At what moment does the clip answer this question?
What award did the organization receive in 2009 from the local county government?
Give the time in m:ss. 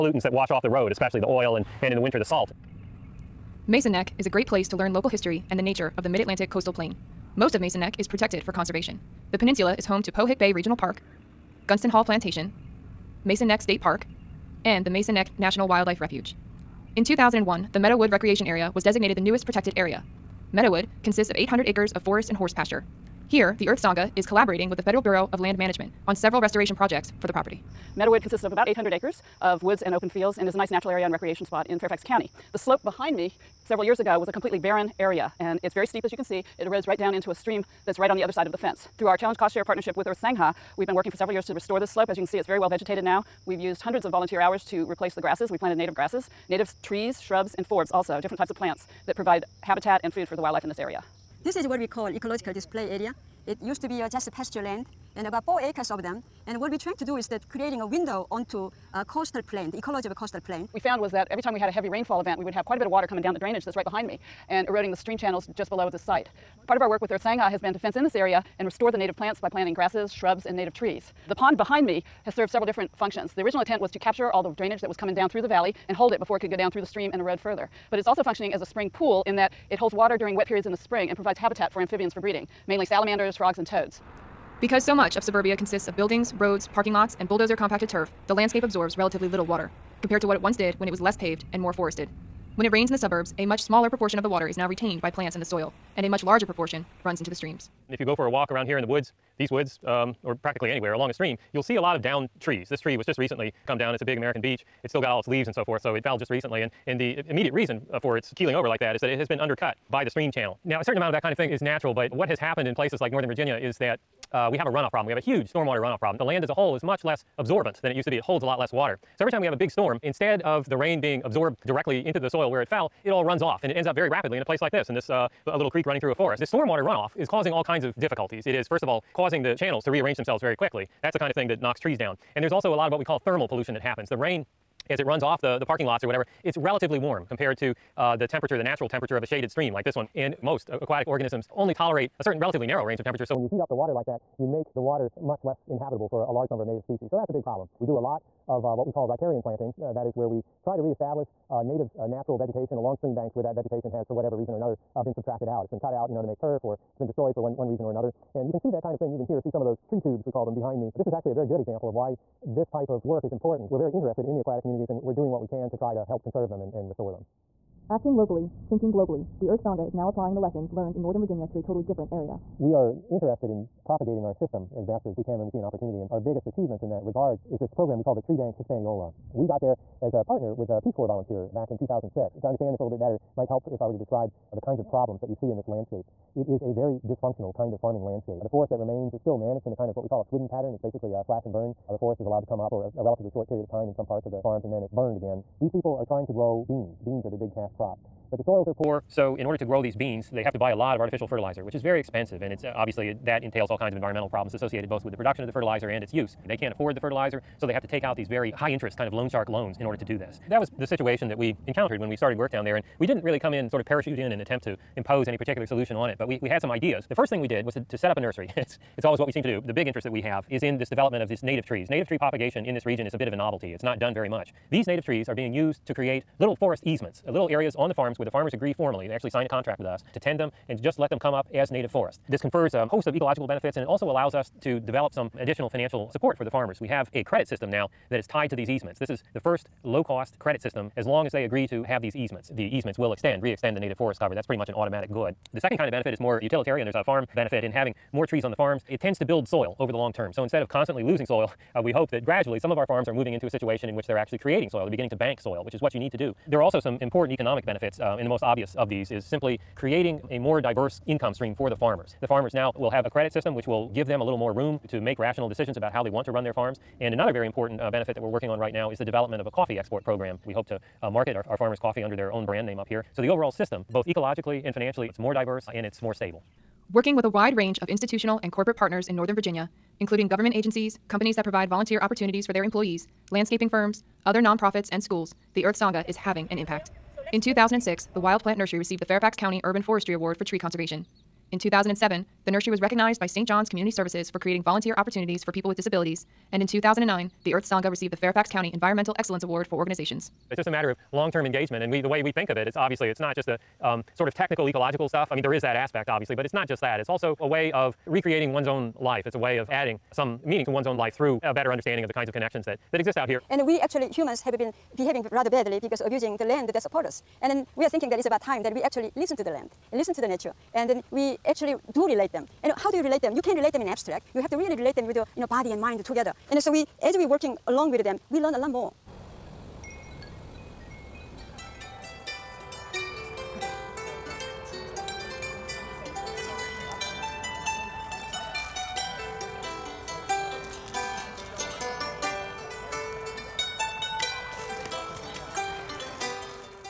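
4:58.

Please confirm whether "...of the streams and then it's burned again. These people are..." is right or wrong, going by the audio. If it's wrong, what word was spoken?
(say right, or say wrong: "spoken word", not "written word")
wrong: "farms", not "streams".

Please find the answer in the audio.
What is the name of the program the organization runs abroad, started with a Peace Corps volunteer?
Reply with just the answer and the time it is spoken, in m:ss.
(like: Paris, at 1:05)
Tree Bank Hispaniola, at 2:58.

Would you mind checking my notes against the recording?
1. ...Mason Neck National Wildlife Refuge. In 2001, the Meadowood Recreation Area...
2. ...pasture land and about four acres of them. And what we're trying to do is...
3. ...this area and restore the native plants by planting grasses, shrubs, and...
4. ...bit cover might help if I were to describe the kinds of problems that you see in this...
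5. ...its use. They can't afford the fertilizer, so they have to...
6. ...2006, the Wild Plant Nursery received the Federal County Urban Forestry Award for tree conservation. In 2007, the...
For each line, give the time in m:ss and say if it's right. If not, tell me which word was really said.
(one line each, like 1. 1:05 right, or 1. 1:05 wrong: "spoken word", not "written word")
1. 0:14 right
2. 0:54 right
3. 1:08 right
4. 3:02 wrong: "better", not "cover"
5. 3:26 right
6. 4:47 wrong: "Fairfax", not "Federal".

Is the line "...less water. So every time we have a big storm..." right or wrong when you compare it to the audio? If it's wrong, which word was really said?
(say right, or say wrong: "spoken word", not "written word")
right.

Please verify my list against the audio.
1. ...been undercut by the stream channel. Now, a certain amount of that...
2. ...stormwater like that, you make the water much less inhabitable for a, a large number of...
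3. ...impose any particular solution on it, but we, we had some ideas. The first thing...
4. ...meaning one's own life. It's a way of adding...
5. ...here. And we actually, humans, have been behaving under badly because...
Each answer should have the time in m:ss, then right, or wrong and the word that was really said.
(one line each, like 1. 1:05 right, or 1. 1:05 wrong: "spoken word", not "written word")
1. 1:49 right
2. 2:23 wrong: "water", not "stormwater"
3. 3:34 right
4. 5:08 wrong: "recreating", not "meaning"
5. 5:13 wrong: "rather", not "under".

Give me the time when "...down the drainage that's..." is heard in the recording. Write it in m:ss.
1:03.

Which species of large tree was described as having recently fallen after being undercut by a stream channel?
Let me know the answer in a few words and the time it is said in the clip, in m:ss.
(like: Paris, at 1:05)
American beech, at 1:44.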